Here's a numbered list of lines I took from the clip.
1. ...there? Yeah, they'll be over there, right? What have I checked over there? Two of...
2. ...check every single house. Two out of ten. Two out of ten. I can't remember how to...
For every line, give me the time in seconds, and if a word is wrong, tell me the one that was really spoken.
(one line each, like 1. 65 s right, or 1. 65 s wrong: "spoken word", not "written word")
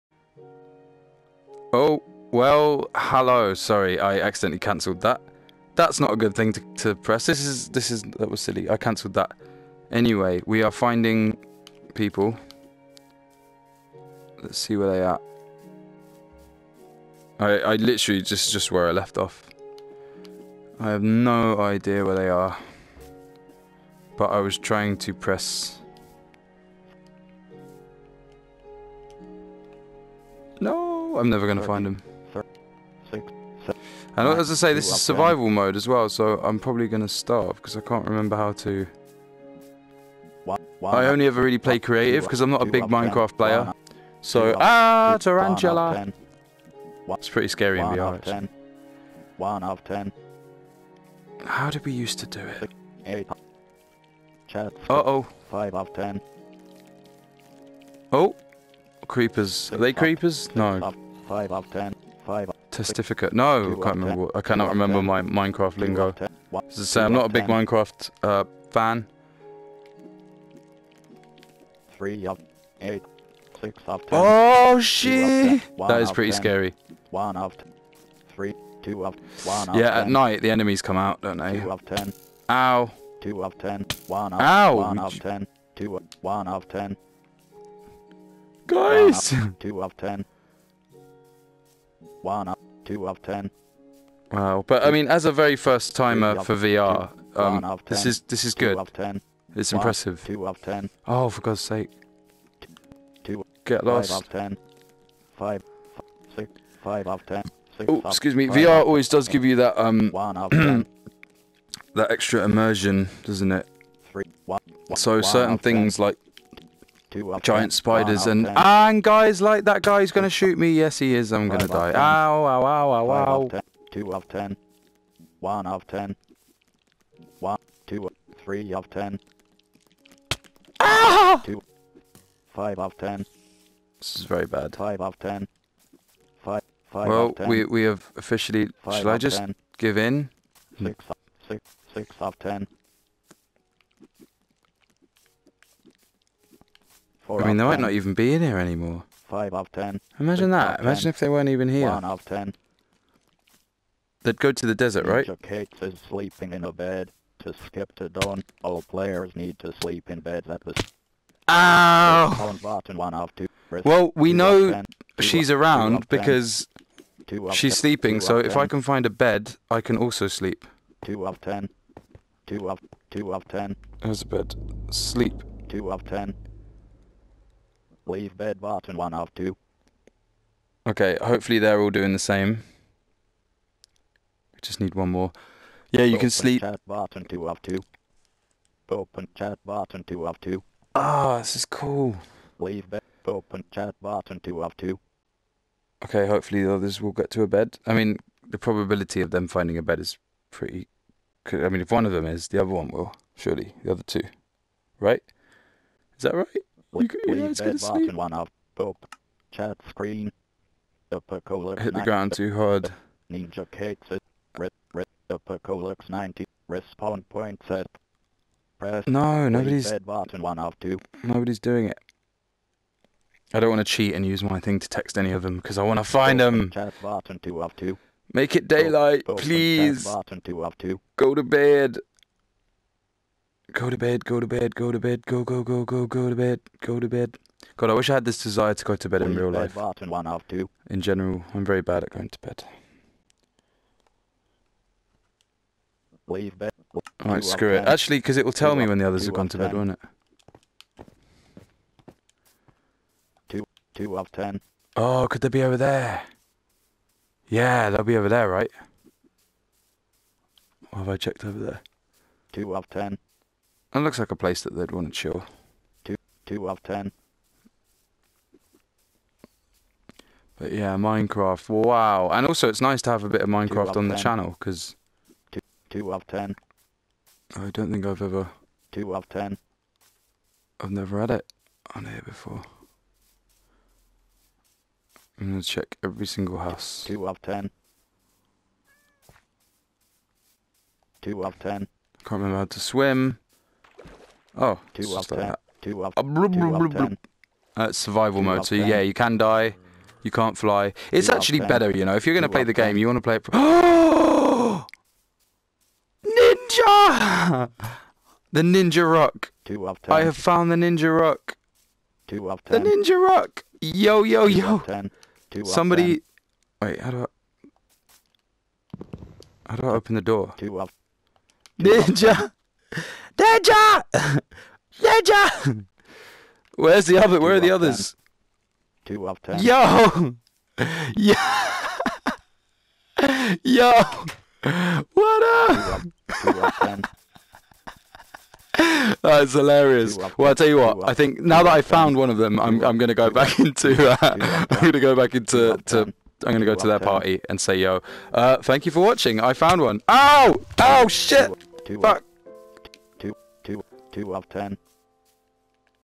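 1. 255 s right
2. 285 s right.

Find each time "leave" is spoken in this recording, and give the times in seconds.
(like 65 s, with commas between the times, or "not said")
178 s, 192 s, 246 s.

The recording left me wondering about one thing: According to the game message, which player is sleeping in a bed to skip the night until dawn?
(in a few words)
Kate.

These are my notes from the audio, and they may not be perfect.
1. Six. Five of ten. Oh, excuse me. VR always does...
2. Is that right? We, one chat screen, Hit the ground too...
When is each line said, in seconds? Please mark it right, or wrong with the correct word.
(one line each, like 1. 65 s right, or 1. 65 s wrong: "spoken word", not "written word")
1. 106 s right
2. 206 s right.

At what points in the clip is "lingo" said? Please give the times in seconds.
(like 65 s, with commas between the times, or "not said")
65 s.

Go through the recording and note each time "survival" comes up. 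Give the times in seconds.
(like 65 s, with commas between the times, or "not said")
35 s, 297 s.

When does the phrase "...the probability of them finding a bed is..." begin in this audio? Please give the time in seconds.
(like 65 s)
198 s.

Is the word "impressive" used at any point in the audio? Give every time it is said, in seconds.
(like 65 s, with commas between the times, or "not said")
99 s.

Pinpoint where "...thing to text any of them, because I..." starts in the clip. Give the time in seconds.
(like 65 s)
224 s.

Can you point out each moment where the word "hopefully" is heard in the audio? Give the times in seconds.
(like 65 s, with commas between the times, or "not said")
181 s, 196 s.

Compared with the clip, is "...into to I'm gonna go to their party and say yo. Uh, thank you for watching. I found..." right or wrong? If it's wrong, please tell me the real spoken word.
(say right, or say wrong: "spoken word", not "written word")
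right.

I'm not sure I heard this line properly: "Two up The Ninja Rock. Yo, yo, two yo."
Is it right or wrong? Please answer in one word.
right.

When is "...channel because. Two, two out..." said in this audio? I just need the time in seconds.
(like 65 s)
274 s.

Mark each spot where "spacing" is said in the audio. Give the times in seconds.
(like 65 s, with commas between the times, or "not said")
not said.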